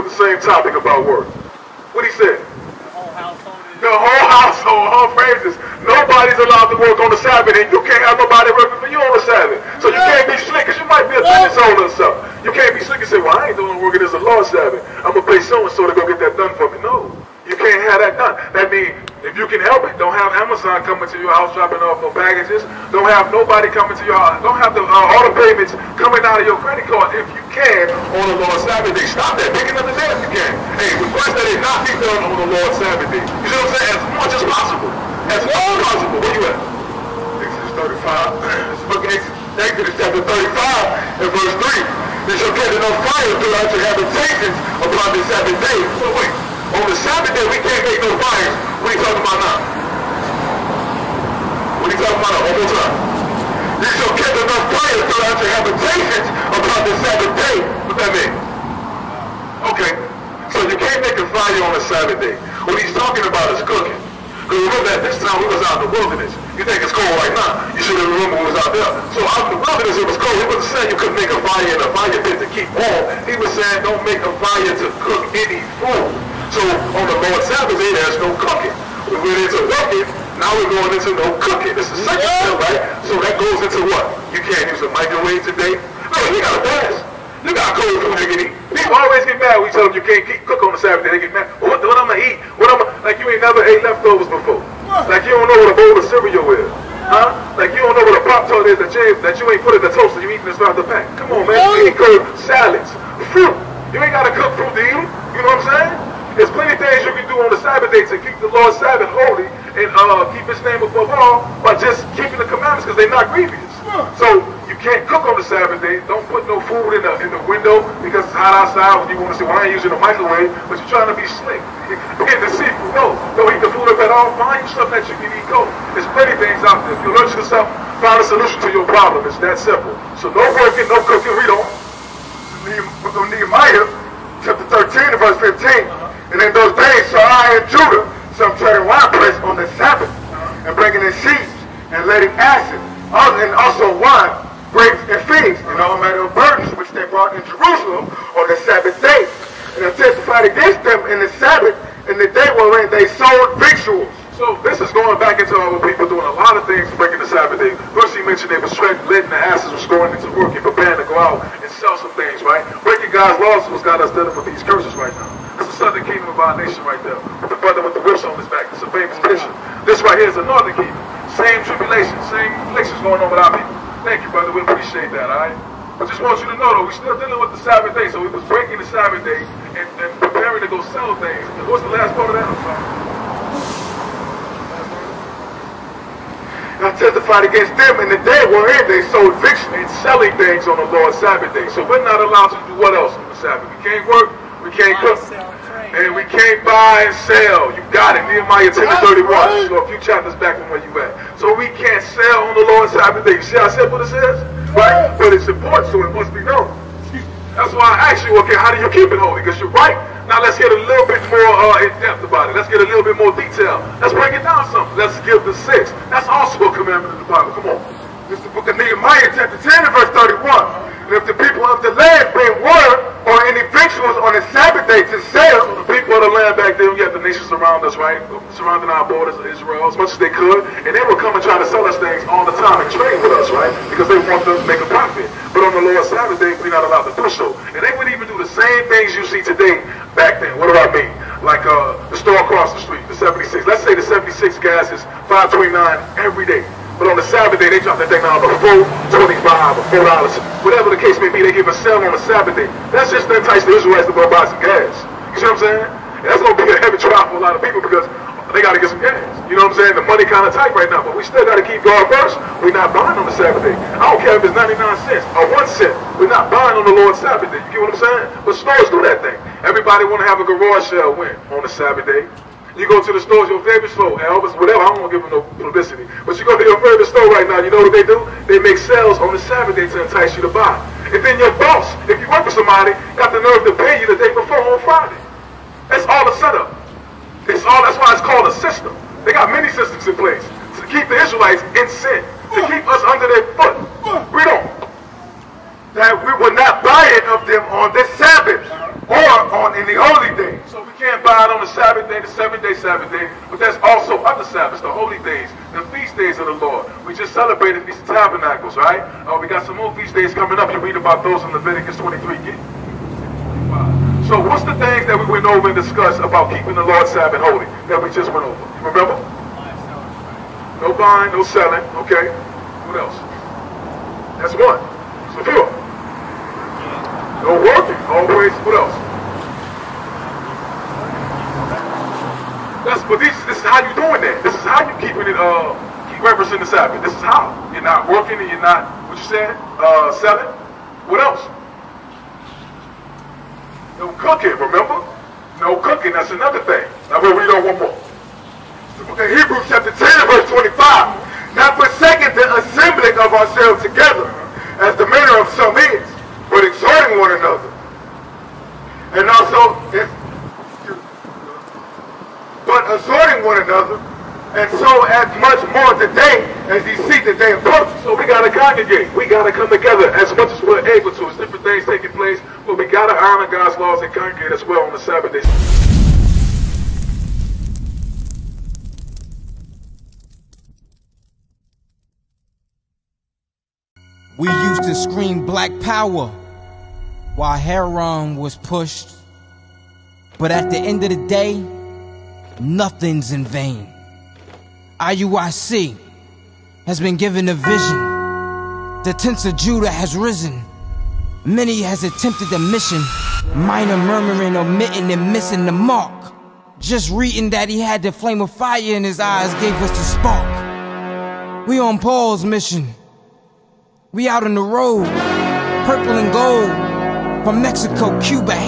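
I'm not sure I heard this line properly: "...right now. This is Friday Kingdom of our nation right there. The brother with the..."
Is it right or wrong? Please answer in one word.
wrong.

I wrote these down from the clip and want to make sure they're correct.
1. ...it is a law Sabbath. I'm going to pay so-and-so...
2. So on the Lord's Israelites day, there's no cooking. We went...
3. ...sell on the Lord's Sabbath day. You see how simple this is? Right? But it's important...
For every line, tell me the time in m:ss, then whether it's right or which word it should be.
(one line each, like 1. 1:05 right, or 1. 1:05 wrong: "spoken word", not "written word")
1. 0:13 right
2. 1:16 wrong: "Sabbath", not "Israelites"
3. 3:22 right.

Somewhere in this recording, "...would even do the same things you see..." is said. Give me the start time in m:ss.
3:57.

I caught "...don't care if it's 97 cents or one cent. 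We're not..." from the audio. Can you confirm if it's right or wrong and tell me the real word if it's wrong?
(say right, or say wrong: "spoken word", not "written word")
wrong: "99", not "97".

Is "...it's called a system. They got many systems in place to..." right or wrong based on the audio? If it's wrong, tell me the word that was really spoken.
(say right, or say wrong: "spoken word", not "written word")
right.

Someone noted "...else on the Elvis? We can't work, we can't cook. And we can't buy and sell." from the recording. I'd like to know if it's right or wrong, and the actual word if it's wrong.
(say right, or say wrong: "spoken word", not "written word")
wrong: "Sabbath", not "Elvis".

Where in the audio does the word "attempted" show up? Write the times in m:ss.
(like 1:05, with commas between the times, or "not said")
6:42.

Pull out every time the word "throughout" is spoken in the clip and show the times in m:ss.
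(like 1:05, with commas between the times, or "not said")
0:43, 0:55.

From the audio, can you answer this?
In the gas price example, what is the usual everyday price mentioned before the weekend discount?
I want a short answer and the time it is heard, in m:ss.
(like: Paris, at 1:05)
529, at 4:05.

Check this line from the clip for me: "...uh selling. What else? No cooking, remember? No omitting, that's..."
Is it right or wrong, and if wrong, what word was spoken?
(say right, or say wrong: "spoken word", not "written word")
wrong: "cooking", not "omitting".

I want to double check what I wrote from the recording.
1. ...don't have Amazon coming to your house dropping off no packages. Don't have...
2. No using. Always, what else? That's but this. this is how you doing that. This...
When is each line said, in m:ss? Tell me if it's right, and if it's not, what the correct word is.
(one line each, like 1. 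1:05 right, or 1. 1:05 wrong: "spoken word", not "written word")
1. 0:19 right
2. 5:27 wrong: "working", not "using".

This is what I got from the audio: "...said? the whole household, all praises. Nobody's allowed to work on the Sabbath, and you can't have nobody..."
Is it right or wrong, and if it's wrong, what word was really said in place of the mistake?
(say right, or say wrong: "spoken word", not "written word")
right.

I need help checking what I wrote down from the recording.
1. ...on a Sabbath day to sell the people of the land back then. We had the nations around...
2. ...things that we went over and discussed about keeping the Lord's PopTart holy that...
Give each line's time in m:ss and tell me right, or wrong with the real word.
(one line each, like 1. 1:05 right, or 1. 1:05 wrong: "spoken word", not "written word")
1. 3:44 right
2. 5:14 wrong: "Sabbath", not "PopTart".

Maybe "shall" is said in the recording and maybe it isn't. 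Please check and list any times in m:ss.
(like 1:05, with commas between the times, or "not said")
0:42, 0:53, 2:17.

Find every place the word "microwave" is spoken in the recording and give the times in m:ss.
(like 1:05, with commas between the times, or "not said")
1:24, 1:59.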